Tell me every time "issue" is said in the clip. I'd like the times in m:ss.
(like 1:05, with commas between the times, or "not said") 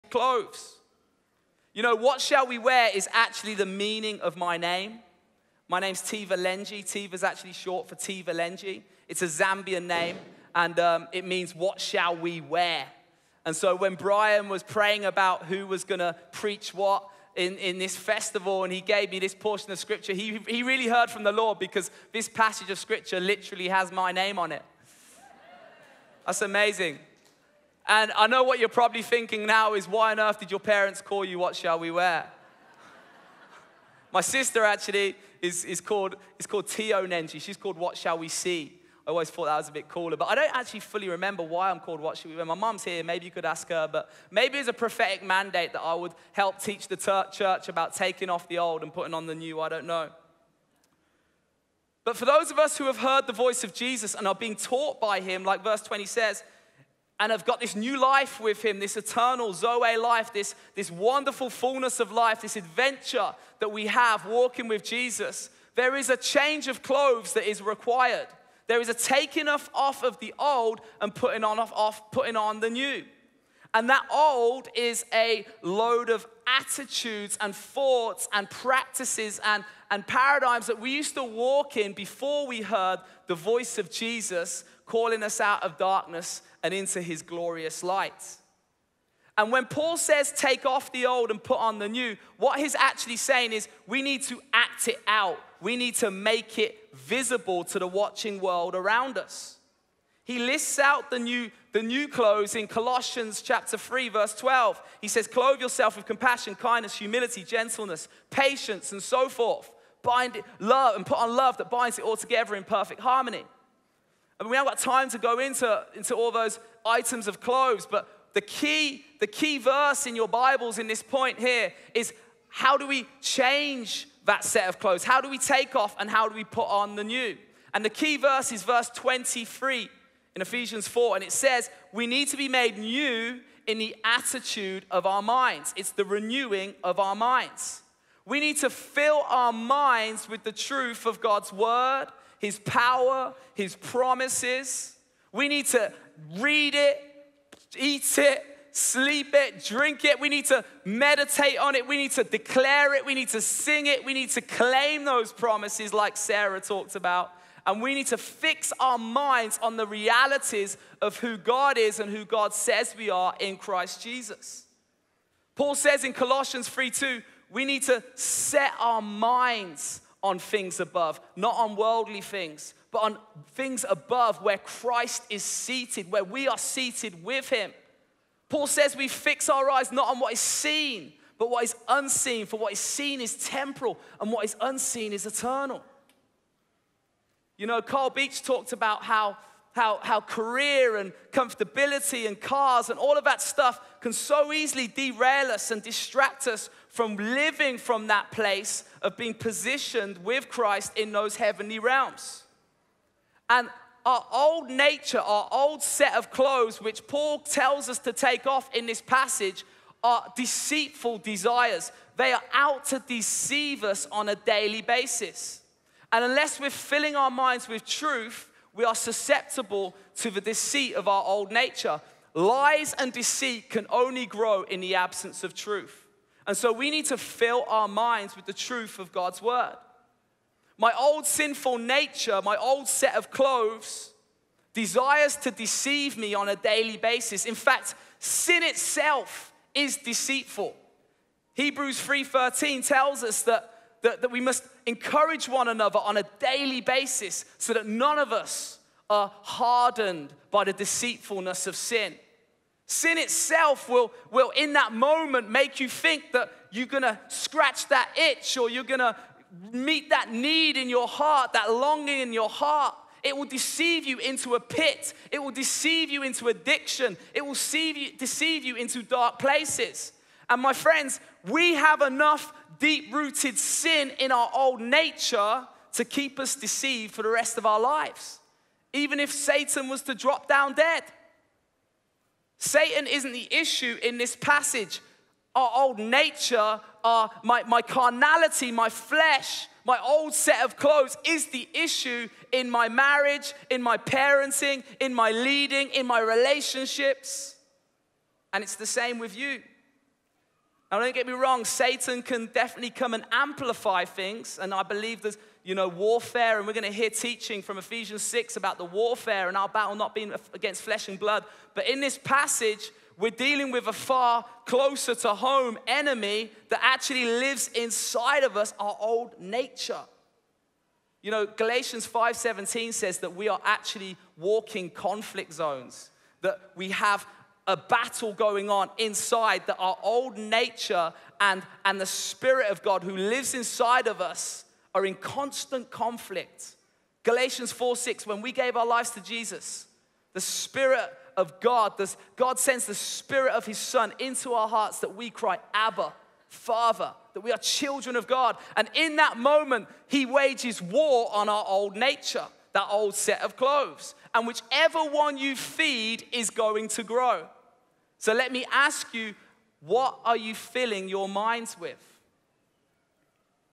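4:43, 4:51.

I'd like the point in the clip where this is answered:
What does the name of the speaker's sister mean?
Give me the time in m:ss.
0:37.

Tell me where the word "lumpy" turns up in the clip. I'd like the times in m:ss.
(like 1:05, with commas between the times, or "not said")
not said.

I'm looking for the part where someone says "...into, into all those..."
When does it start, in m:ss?
1:55.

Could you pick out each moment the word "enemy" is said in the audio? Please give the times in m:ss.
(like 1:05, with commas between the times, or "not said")
5:15.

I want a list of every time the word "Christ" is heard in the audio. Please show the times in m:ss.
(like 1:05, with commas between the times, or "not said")
2:43, 2:54, 3:20.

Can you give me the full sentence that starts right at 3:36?
And unless we're filling our minds with truth, we are susceptible to the deceit of our old nature.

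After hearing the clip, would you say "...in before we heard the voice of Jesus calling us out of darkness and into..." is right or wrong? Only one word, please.
right.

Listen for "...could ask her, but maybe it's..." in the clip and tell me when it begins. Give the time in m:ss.
0:43.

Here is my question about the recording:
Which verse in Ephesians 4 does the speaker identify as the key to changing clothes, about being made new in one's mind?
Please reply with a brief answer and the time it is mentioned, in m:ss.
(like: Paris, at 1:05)
Verse 23, at 2:08.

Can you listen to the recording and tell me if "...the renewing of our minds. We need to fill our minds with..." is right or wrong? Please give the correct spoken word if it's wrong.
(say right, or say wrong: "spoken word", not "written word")
right.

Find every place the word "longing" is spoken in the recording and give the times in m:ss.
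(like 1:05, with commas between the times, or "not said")
4:21.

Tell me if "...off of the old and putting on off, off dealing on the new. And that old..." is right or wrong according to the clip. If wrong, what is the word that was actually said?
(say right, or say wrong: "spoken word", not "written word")
wrong: "putting", not "dealing".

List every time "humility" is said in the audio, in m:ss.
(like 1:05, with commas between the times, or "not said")
1:46.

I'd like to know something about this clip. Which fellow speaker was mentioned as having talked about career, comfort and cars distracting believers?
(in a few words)
Carl Beach.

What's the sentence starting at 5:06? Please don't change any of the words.
And we're going to hear teaching from Ephesians 6 about the warfare and our battle not being against flesh and blood.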